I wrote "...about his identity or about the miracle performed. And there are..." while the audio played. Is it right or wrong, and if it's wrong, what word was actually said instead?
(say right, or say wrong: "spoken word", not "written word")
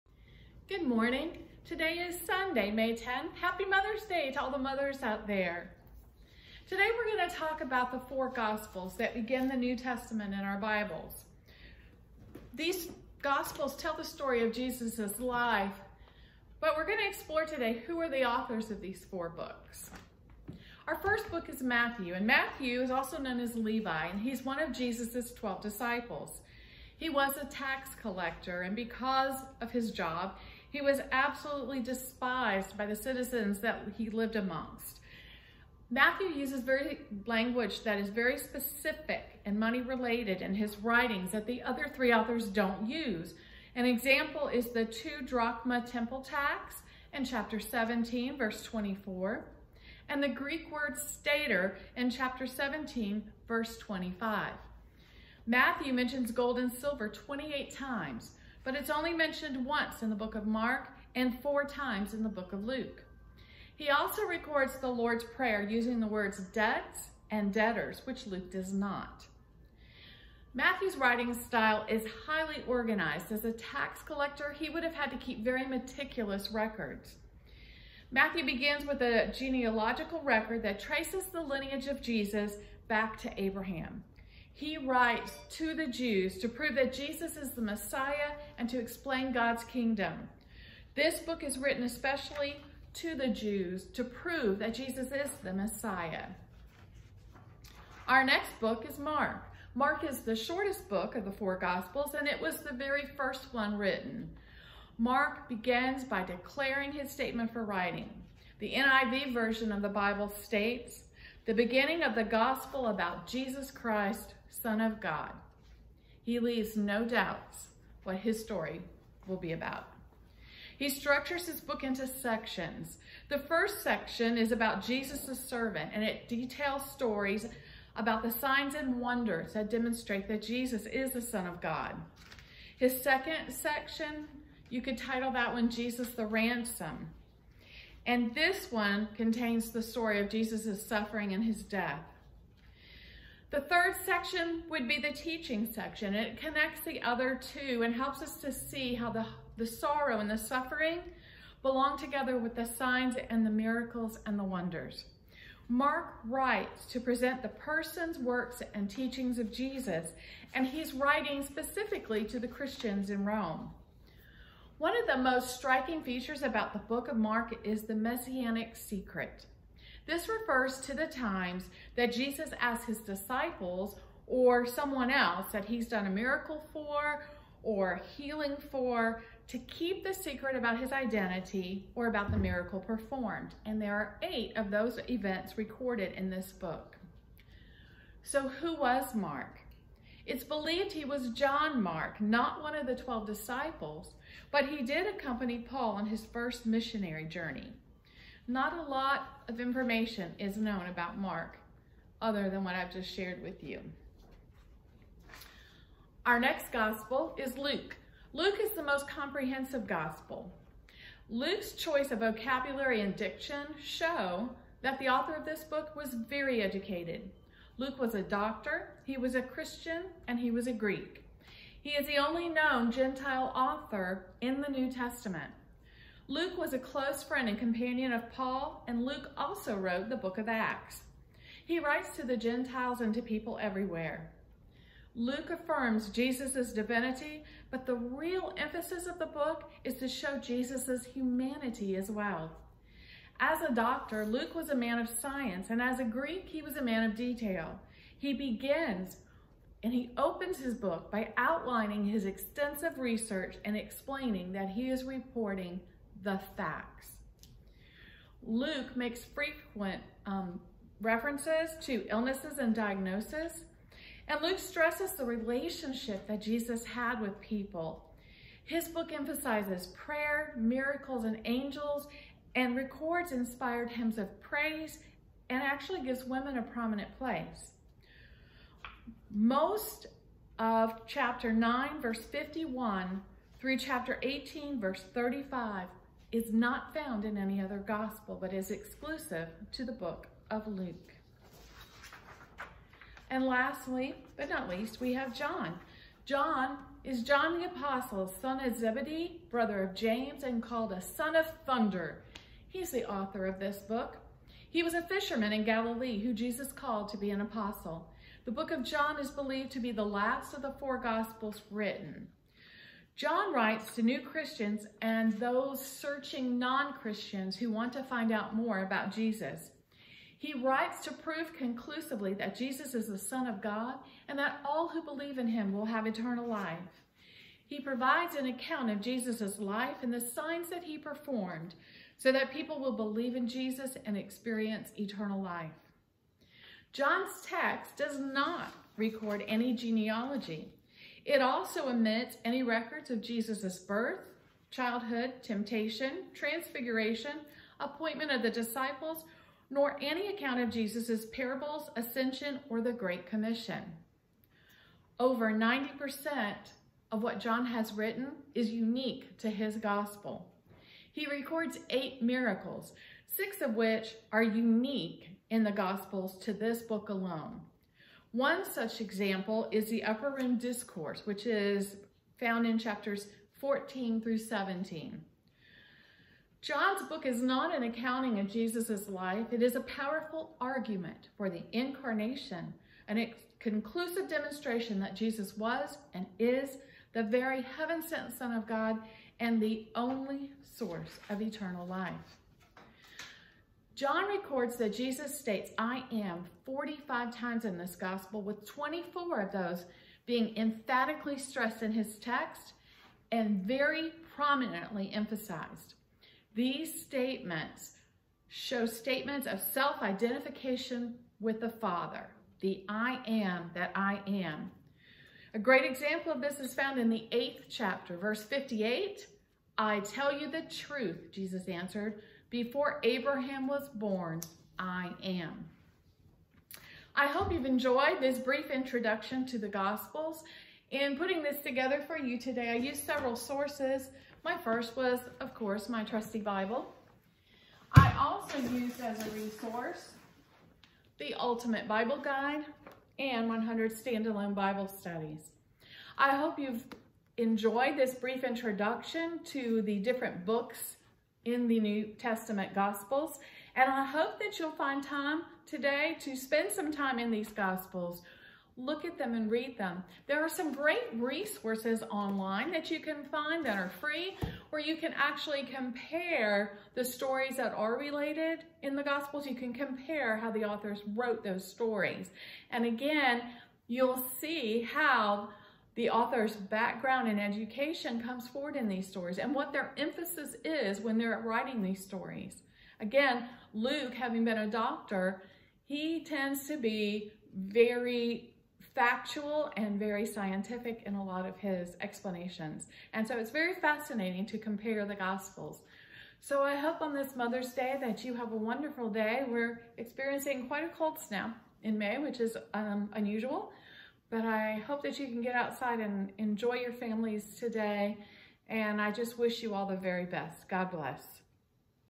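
right.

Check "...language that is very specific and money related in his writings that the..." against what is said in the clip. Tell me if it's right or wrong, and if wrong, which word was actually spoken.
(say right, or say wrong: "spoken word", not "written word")
right.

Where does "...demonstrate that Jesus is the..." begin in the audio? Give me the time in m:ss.
2:09.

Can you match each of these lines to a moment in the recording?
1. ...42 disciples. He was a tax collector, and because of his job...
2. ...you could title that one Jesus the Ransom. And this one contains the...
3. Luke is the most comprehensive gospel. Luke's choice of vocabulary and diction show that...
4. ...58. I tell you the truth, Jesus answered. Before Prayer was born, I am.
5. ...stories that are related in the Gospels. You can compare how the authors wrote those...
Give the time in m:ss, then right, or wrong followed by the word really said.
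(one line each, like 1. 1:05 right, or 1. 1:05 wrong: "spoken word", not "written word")
1. 0:25 wrong: "12", not "42"
2. 2:14 right
3. 3:28 right
4. 6:58 wrong: "Abraham", not "Prayer"
5. 7:47 right.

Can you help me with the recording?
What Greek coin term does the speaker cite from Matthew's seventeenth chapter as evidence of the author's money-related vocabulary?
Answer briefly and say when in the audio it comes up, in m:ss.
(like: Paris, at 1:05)
stater, at 0:50.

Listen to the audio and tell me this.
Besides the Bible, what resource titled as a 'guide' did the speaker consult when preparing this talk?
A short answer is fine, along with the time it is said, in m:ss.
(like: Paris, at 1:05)
Ultimate Bible Guide, at 7:21.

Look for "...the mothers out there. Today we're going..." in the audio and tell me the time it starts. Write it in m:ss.
0:04.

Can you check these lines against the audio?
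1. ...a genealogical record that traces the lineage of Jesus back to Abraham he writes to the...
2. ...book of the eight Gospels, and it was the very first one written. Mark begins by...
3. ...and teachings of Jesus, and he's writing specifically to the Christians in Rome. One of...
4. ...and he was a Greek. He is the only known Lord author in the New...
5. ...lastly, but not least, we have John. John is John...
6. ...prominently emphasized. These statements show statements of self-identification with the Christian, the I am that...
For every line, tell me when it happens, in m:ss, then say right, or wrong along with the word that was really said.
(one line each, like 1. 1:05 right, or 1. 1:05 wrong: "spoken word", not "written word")
1. 1:19 right
2. 1:40 wrong: "four", not "eight"
3. 2:38 right
4. 3:40 wrong: "Gentile", not "Lord"
5. 4:53 right
6. 6:44 wrong: "Father", not "Christian".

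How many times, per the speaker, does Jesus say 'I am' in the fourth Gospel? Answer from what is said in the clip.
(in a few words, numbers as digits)
45.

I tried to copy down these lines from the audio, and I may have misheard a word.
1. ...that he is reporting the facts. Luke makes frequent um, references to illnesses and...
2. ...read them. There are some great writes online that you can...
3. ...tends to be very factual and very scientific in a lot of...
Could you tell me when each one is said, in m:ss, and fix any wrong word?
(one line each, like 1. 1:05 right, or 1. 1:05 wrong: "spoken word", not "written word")
1. 4:14 right
2. 7:39 wrong: "resources", not "writes"
3. 8:06 right.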